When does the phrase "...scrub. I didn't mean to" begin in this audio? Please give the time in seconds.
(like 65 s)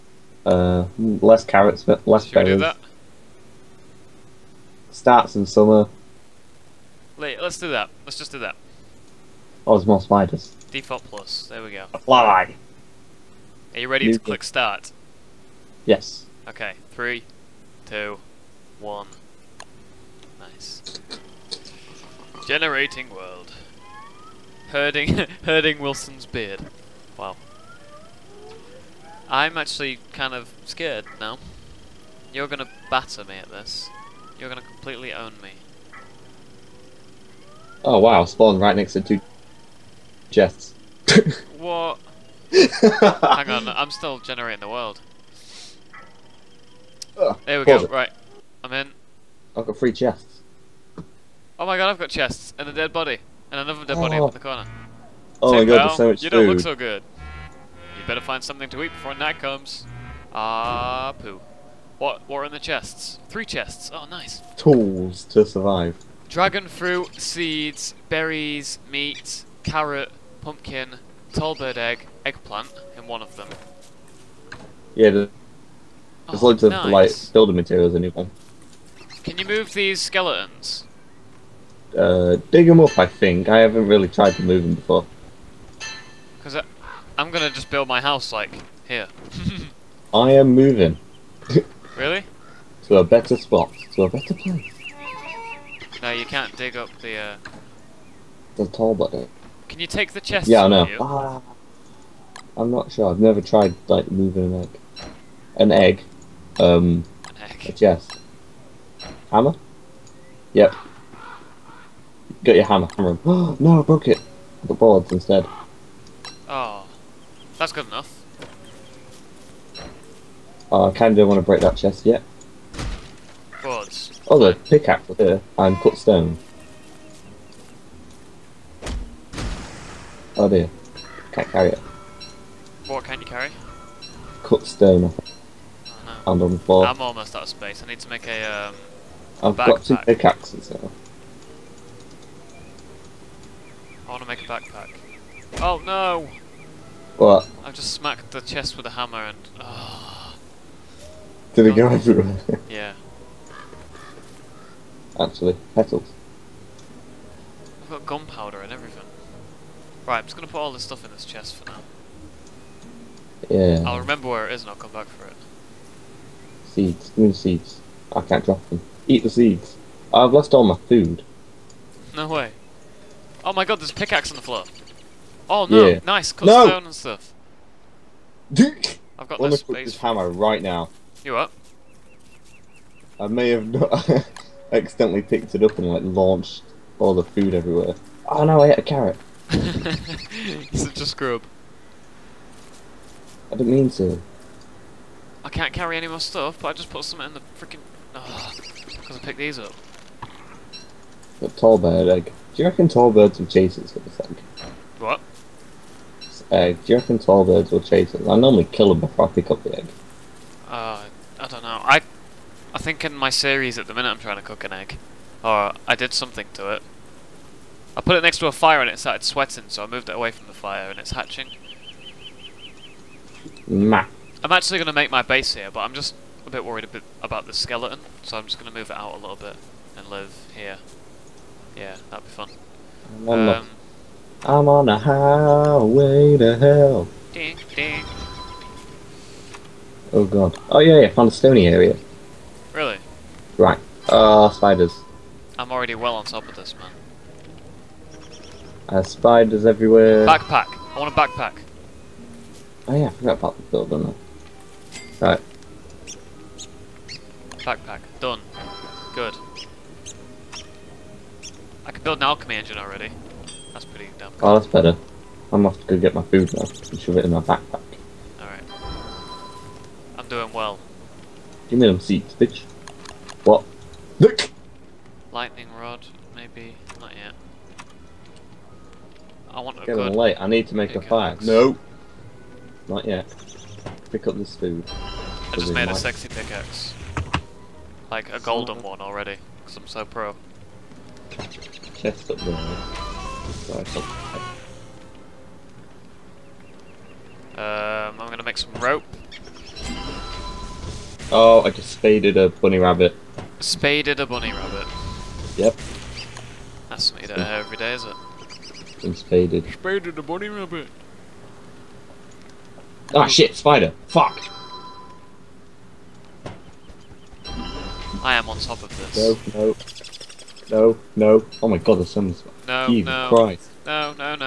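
191 s.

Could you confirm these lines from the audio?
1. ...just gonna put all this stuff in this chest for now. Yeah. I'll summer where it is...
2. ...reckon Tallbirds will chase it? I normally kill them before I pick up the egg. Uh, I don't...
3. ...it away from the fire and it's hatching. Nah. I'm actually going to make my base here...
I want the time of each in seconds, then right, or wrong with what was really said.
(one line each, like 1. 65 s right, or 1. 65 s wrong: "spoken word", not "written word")
1. 160 s wrong: "remember", not "summer"
2. 206 s right
3. 220 s right.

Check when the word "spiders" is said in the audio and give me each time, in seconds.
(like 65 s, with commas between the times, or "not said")
10 s, 244 s, 249 s, 313 s.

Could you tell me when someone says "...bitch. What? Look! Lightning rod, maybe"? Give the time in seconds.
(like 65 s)
272 s.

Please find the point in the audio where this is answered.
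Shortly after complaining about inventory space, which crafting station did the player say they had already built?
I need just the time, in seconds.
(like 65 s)
262 s.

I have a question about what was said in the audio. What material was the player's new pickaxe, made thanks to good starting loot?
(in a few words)
Golden.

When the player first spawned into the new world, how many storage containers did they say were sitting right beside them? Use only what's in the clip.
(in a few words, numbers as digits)
2.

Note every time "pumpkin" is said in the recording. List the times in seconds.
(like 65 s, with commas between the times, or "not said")
70 s.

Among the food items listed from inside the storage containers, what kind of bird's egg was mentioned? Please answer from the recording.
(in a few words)
Tall bird egg.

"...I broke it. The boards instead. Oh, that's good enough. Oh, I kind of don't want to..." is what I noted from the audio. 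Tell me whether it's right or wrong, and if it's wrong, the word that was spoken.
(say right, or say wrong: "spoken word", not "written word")
right.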